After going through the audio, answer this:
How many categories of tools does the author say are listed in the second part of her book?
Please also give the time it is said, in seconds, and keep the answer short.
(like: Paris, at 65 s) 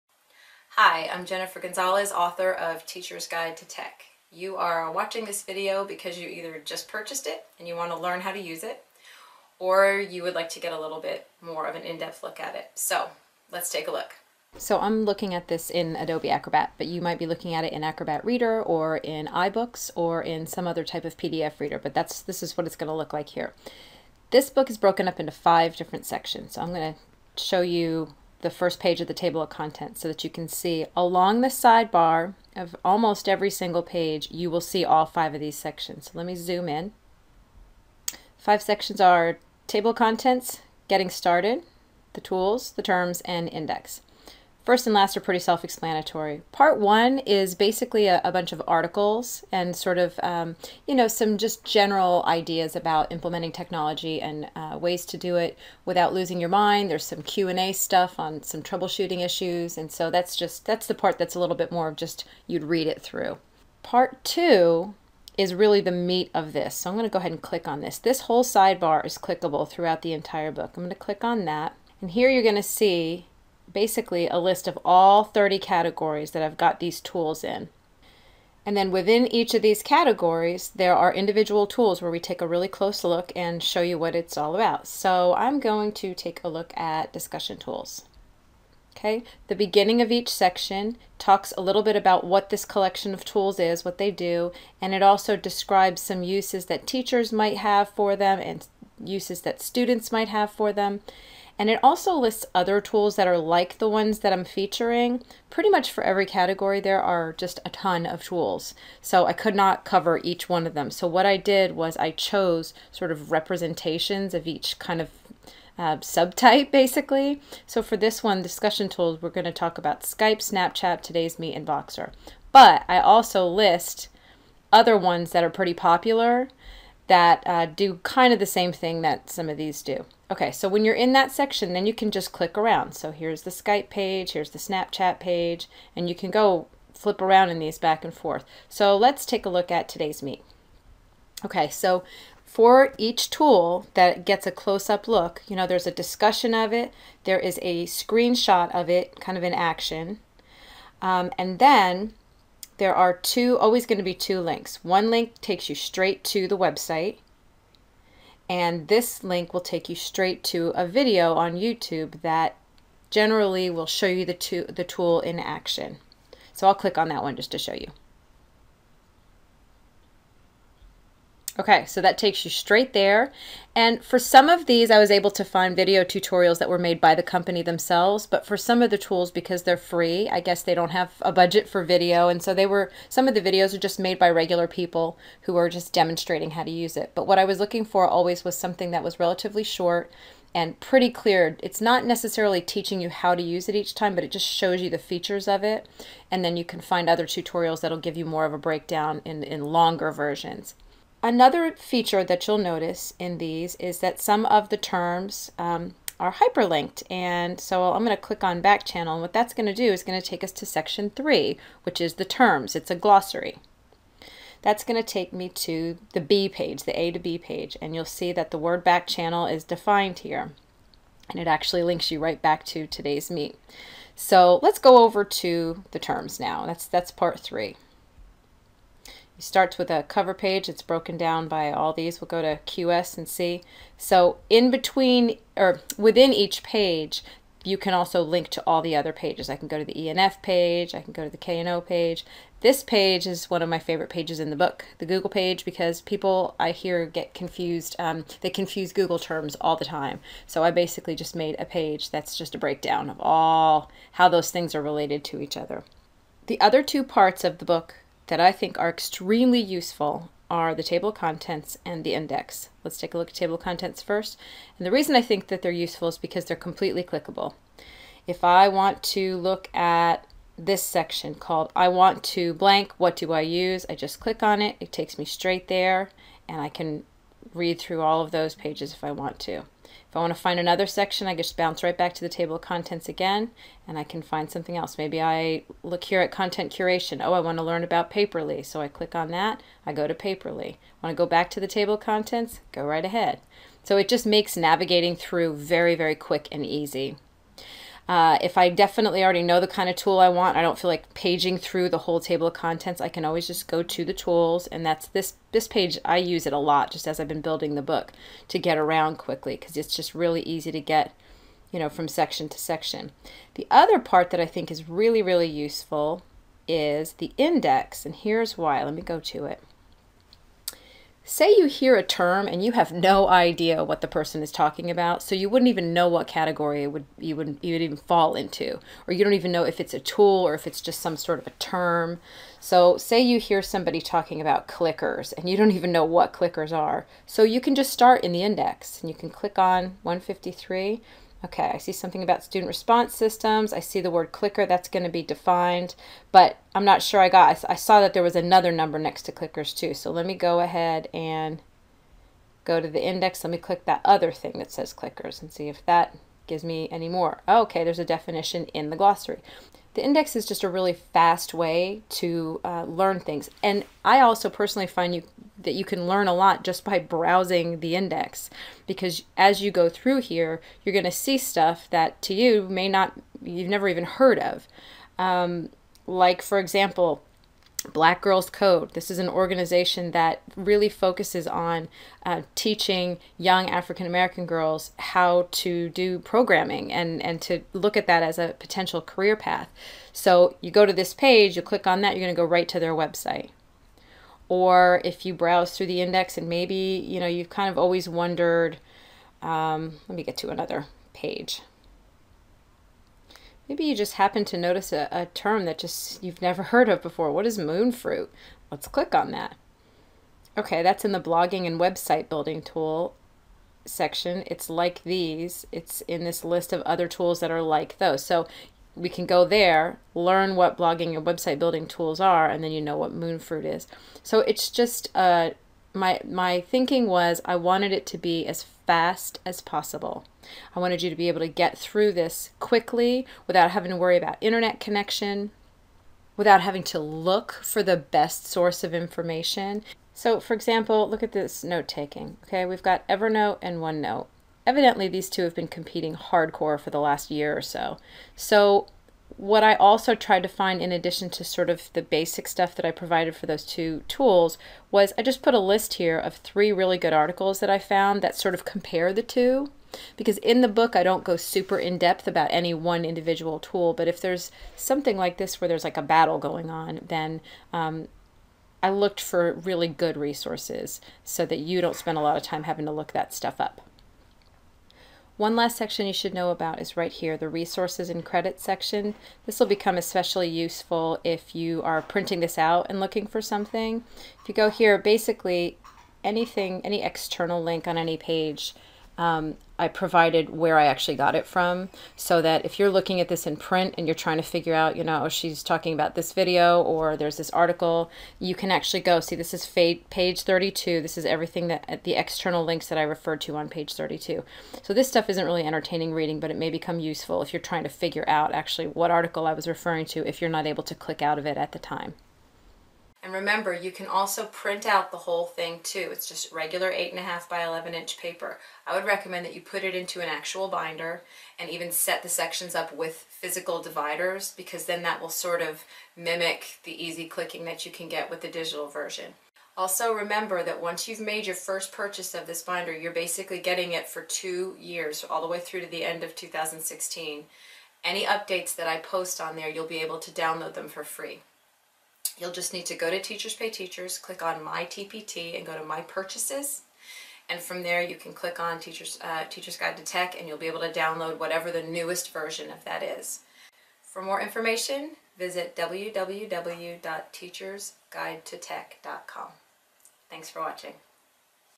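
30, at 75 s.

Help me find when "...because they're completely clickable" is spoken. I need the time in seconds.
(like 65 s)
266 s.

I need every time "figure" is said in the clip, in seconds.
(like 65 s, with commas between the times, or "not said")
494 s, 507 s.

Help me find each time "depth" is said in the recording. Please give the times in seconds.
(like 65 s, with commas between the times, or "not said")
11 s, 461 s.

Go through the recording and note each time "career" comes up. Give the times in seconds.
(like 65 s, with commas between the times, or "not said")
389 s.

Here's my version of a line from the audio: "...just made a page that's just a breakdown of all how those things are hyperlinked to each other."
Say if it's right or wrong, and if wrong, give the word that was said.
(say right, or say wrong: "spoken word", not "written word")
wrong: "related", not "hyperlinked".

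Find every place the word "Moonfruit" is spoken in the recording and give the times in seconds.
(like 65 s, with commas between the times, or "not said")
407 s, 423 s.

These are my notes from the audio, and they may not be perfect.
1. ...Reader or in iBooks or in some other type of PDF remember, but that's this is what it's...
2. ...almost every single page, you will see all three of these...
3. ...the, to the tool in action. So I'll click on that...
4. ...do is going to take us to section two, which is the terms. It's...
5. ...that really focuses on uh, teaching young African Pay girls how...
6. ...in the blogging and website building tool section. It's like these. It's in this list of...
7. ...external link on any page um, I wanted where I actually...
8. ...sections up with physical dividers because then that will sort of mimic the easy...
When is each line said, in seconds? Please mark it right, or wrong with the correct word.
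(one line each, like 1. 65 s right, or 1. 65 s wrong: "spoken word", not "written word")
1. 18 s wrong: "reader", not "remember"
2. 32 s wrong: "five", not "three"
3. 164 s right
4. 209 s wrong: "three", not "two"
5. 380 s wrong: "American", not "Pay"
6. 411 s right
7. 487 s wrong: "provided", not "wanted"
8. 522 s right.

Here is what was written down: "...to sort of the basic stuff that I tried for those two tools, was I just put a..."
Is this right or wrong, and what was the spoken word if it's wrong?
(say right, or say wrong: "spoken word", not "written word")
wrong: "provided", not "tried".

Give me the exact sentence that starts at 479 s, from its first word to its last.
This will become especially useful if you are printing this out and looking for something.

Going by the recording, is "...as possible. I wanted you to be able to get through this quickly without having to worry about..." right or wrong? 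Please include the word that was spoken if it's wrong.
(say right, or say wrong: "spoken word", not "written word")
right.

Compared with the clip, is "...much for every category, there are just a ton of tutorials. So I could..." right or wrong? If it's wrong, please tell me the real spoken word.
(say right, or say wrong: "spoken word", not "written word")
wrong: "tools", not "tutorials".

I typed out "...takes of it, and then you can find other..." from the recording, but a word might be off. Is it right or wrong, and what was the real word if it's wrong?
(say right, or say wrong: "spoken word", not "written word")
wrong: "features", not "takes".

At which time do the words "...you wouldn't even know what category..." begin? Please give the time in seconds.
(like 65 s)
325 s.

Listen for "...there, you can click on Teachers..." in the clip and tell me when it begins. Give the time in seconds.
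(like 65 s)
547 s.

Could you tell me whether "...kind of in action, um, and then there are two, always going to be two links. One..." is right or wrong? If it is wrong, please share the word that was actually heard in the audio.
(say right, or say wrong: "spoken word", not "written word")
right.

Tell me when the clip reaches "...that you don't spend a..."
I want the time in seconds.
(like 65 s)
471 s.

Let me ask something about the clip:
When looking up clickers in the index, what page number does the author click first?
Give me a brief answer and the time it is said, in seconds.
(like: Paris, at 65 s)
153, at 340 s.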